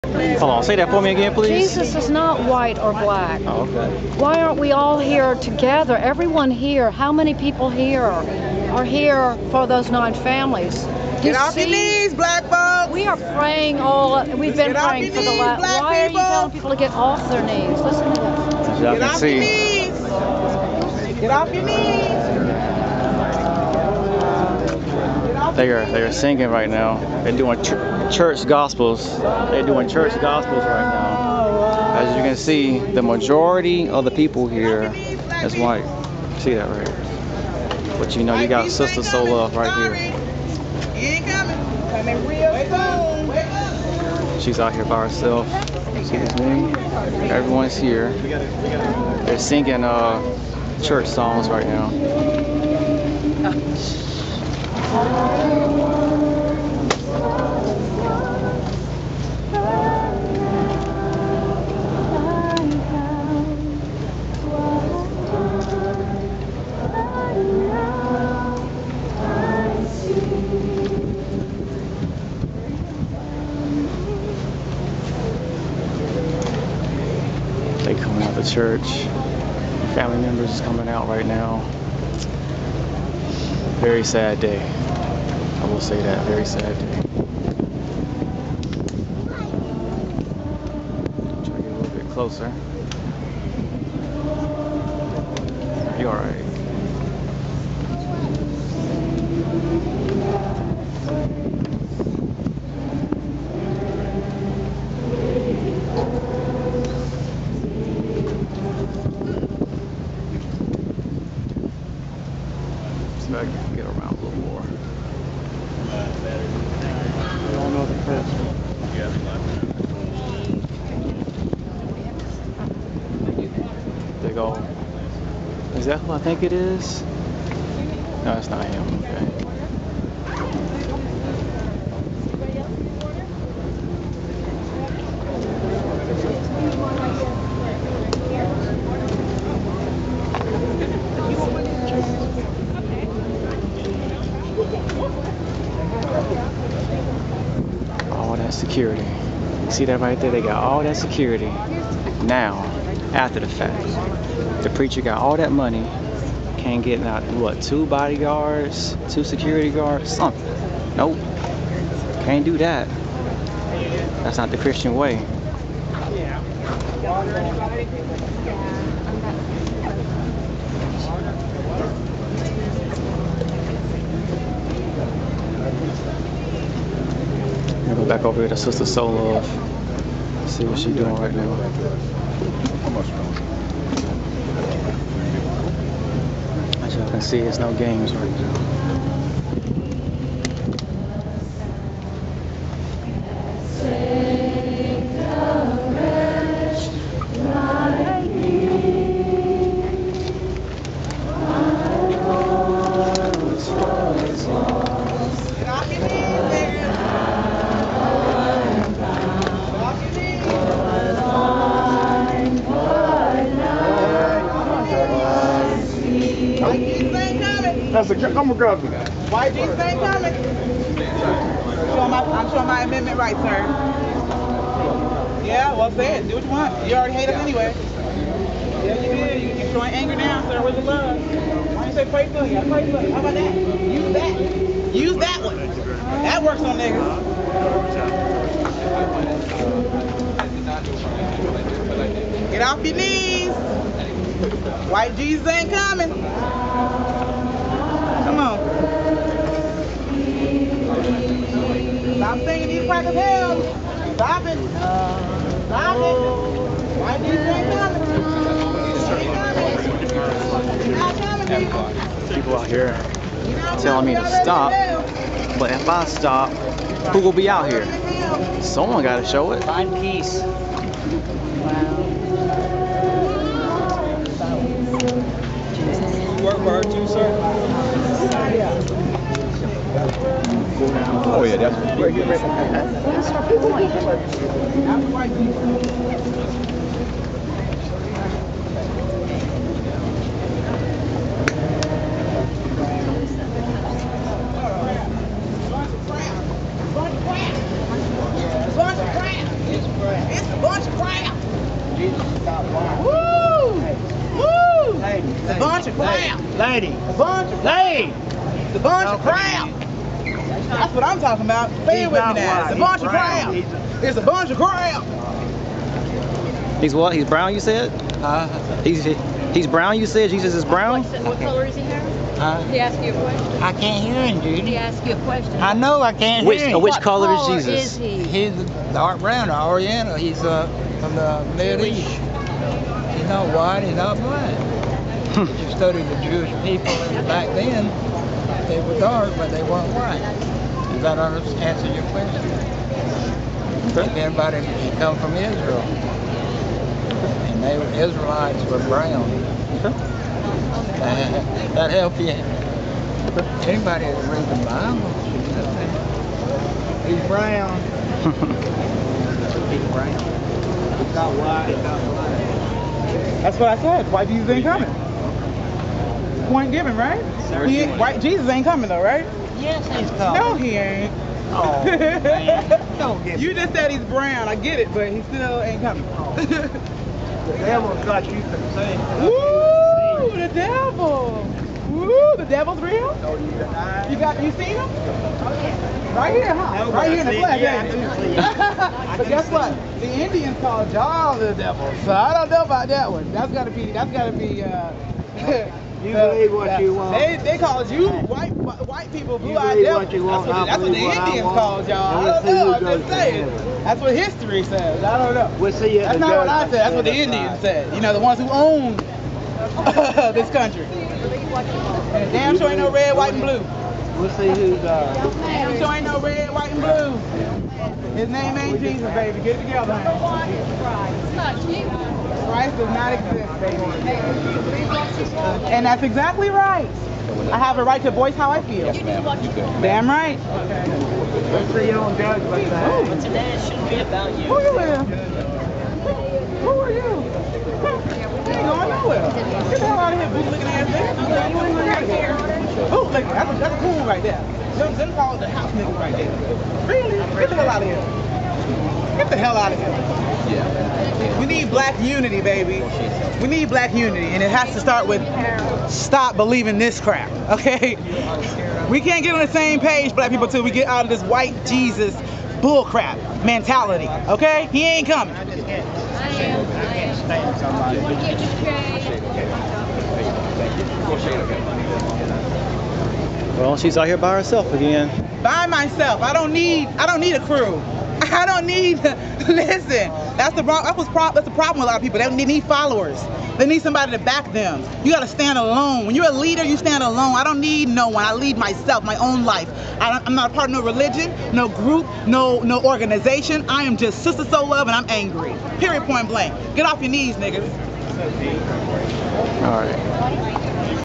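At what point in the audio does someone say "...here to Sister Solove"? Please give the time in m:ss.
2:58.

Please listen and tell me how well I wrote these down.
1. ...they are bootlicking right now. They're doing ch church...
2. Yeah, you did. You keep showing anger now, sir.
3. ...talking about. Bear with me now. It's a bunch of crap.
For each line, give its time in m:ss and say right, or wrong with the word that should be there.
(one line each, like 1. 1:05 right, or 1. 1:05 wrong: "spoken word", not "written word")
1. 0:25 wrong: "singing", not "bootlicking"
2. 3:48 right
3. 5:11 right.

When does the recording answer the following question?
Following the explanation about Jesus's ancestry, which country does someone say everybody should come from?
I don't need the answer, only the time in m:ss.
5:45.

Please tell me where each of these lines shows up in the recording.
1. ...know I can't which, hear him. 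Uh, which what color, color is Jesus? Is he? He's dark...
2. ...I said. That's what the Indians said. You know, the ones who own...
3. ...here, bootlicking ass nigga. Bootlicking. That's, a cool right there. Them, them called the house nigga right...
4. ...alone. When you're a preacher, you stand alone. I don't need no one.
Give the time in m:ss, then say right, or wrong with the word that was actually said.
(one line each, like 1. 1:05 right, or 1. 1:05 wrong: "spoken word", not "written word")
1. 5:25 right
2. 6:46 right
3. 7:20 right
4. 8:05 wrong: "leader", not "preacher".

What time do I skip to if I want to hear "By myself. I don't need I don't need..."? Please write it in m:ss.
7:55.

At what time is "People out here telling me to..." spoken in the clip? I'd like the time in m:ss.
4:22.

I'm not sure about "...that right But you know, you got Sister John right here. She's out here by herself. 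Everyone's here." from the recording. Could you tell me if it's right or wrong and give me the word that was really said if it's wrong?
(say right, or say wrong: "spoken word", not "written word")
wrong: "Solove", not "John".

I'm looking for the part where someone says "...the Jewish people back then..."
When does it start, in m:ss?
5:36.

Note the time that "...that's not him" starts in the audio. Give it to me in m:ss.
2:08.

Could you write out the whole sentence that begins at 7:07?
I have a right to voice how I feel.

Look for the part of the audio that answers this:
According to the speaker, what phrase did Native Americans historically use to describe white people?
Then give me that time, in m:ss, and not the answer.
6:39.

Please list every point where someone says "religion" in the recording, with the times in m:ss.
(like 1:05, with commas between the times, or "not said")
8:10.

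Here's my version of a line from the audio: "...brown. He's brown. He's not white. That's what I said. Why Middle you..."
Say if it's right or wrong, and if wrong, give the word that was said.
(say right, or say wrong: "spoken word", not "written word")
wrong: "Jesus", not "Middle".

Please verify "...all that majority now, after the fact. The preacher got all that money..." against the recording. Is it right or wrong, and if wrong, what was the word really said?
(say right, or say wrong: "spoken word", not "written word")
wrong: "security", not "majority".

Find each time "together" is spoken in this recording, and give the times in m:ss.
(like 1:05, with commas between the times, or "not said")
0:05, 6:59.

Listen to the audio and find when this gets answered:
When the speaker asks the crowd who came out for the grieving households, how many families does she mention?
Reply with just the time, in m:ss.
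0:09.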